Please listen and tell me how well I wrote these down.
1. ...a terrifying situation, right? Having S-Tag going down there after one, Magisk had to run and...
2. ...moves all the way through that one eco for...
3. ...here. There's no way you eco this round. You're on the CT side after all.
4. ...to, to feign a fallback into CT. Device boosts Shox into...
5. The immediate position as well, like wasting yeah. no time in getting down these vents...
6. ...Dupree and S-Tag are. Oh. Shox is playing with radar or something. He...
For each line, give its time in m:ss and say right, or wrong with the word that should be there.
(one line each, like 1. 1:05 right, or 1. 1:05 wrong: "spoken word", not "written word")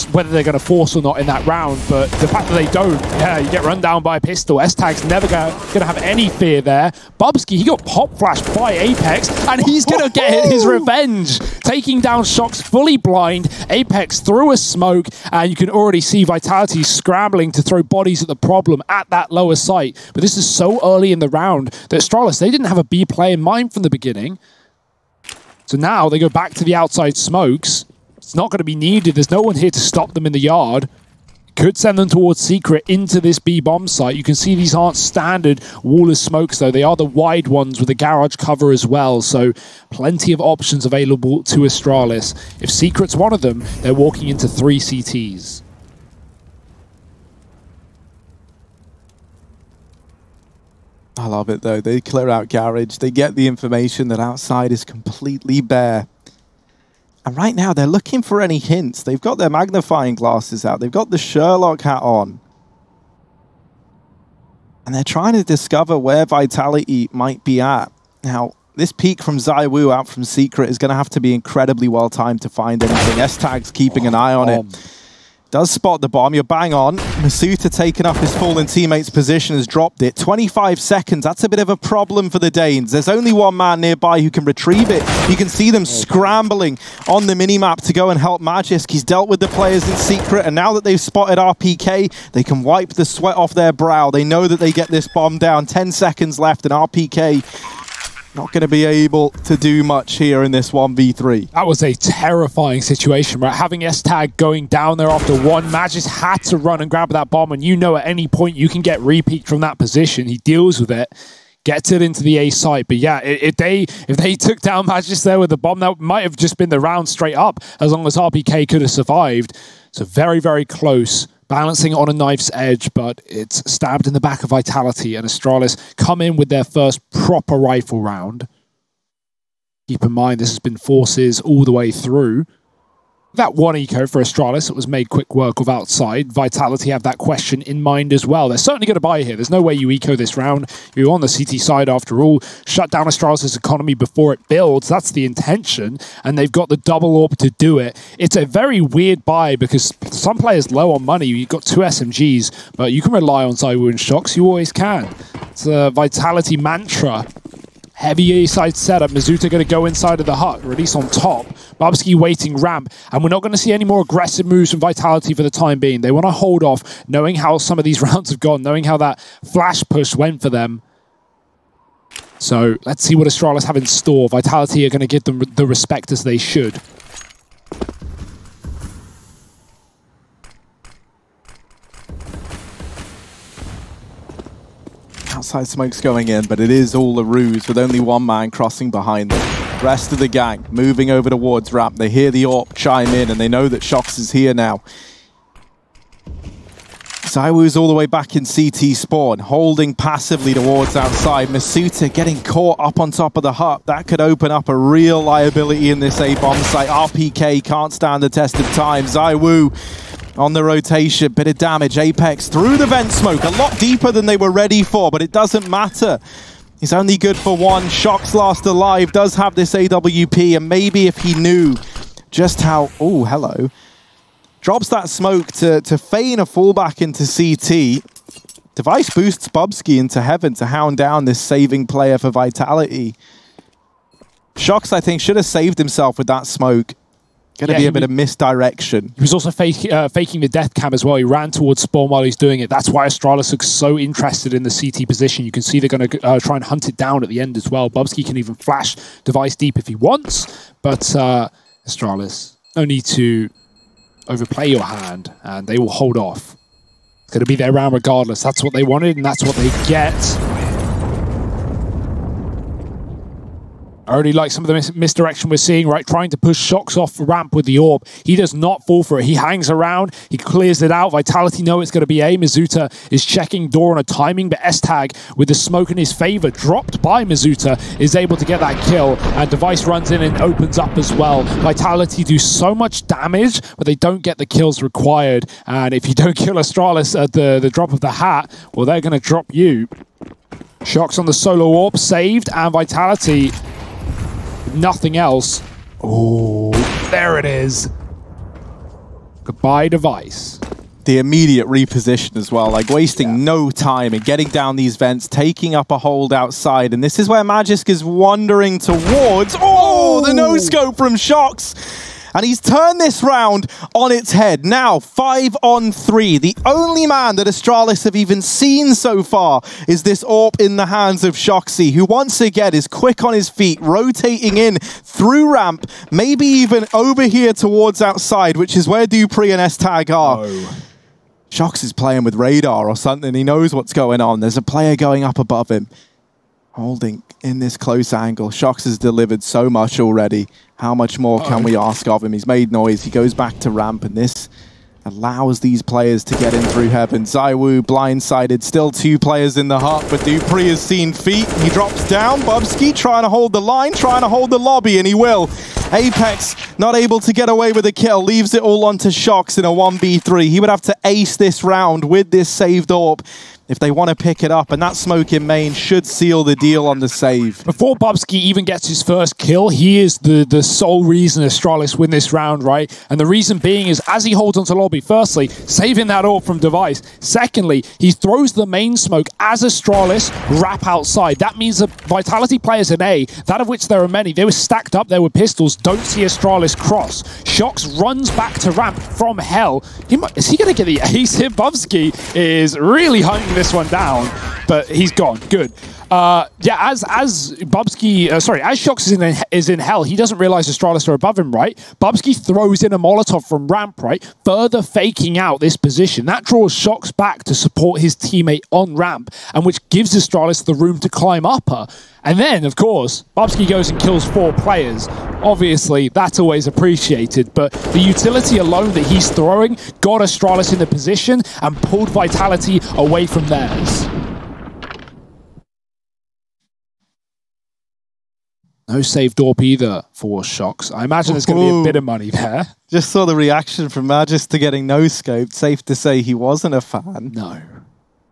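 1. 1:41 right
2. 2:10 wrong: "forces", not "moves"
3. 2:19 right
4. 3:45 wrong: "Bubzkji", not "Shox"
5. 5:01 wrong: "reposition", not "position"
6. 5:29 right.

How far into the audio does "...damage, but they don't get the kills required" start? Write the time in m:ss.
4:43.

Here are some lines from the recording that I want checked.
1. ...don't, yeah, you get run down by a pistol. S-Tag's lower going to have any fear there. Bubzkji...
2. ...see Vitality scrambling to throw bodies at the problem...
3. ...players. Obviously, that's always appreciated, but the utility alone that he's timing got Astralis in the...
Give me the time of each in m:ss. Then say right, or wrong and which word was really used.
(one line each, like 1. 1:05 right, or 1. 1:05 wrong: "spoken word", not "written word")
1. 0:02 wrong: "never", not "lower"
2. 0:16 right
3. 6:54 wrong: "throwing", not "timing".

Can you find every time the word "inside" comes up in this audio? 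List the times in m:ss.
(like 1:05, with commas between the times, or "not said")
2:39.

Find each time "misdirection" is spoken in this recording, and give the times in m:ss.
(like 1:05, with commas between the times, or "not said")
3:58, 4:24.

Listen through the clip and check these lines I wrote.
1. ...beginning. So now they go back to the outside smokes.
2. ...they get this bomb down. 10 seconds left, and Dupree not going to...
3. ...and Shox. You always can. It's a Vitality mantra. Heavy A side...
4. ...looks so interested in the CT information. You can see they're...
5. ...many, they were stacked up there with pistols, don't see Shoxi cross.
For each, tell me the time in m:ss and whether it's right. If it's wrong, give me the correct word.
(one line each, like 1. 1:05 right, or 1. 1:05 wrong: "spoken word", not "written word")
1. 0:23 right
2. 1:34 wrong: "RPK", not "Dupree"
3. 2:33 right
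4. 4:03 wrong: "position", not "information"
5. 6:24 wrong: "Astralis", not "Shoxi".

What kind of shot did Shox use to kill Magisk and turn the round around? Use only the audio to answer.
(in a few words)
no scope.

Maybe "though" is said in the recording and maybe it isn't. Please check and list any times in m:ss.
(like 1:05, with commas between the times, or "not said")
0:36, 0:51.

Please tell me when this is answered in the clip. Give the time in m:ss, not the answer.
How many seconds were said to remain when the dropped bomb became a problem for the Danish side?
1:20.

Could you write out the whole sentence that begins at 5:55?
Apex not able to get away with a kill, leaves it all onto Shox in a 1v3.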